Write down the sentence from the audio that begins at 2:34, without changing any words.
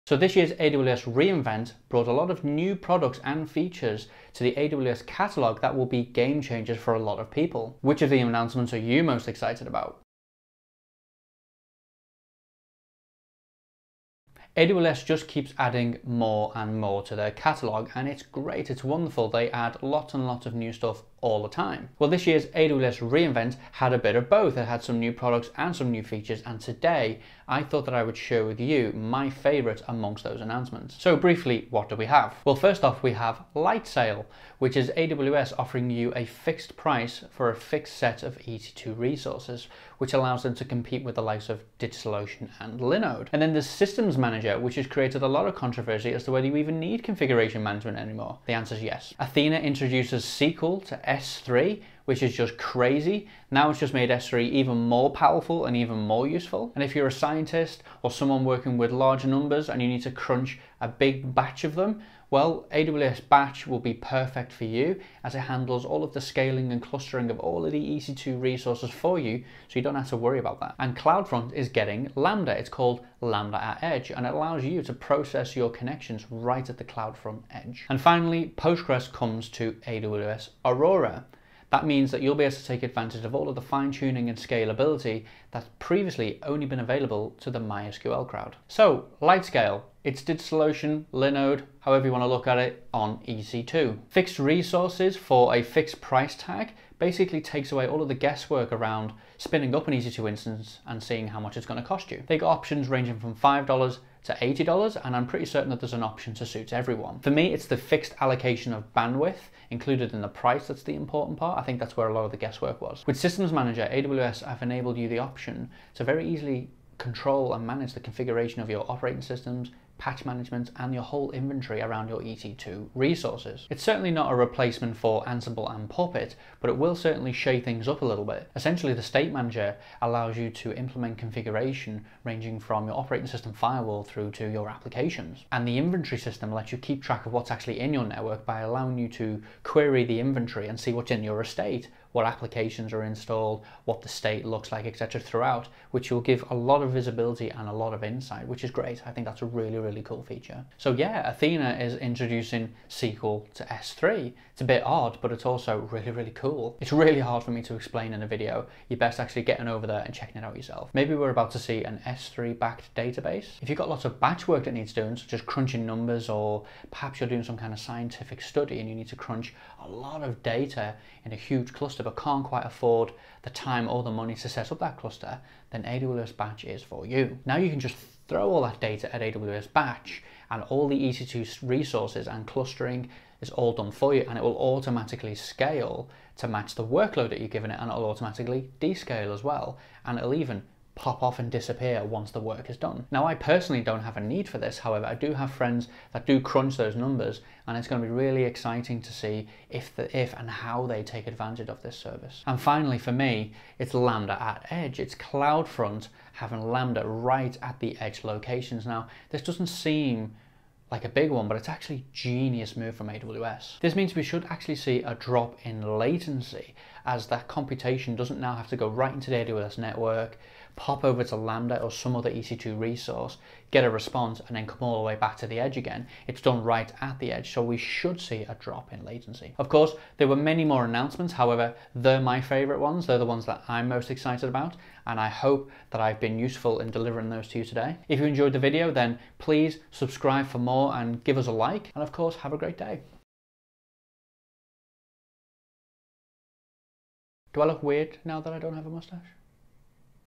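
It's a bit odd, but it's also really, really cool.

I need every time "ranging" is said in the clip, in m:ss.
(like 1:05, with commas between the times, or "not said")
1:42, 2:12.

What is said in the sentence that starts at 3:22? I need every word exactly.
And finally for me, it's Lambda at Edge.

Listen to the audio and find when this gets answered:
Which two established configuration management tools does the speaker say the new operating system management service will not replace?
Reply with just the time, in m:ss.
2:05.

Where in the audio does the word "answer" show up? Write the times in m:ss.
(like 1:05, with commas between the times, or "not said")
0:48.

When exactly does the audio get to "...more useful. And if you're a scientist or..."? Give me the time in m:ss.
0:55.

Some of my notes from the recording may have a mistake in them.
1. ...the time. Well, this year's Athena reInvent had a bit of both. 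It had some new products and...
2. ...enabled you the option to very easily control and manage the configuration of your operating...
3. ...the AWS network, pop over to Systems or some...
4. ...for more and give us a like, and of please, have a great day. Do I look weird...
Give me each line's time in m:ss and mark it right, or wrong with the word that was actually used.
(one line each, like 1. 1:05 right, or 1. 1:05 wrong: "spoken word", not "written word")
1. 0:21 wrong: "AWS", not "Athena"
2. 1:54 right
3. 3:39 wrong: "Lambda", not "Systems"
4. 4:00 wrong: "course", not "please".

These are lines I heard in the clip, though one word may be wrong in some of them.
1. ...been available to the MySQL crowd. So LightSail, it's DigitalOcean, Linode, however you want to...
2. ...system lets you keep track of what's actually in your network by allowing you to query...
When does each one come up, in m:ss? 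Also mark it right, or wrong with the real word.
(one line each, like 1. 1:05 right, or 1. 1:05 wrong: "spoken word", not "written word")
1. 1:26 right
2. 2:16 right.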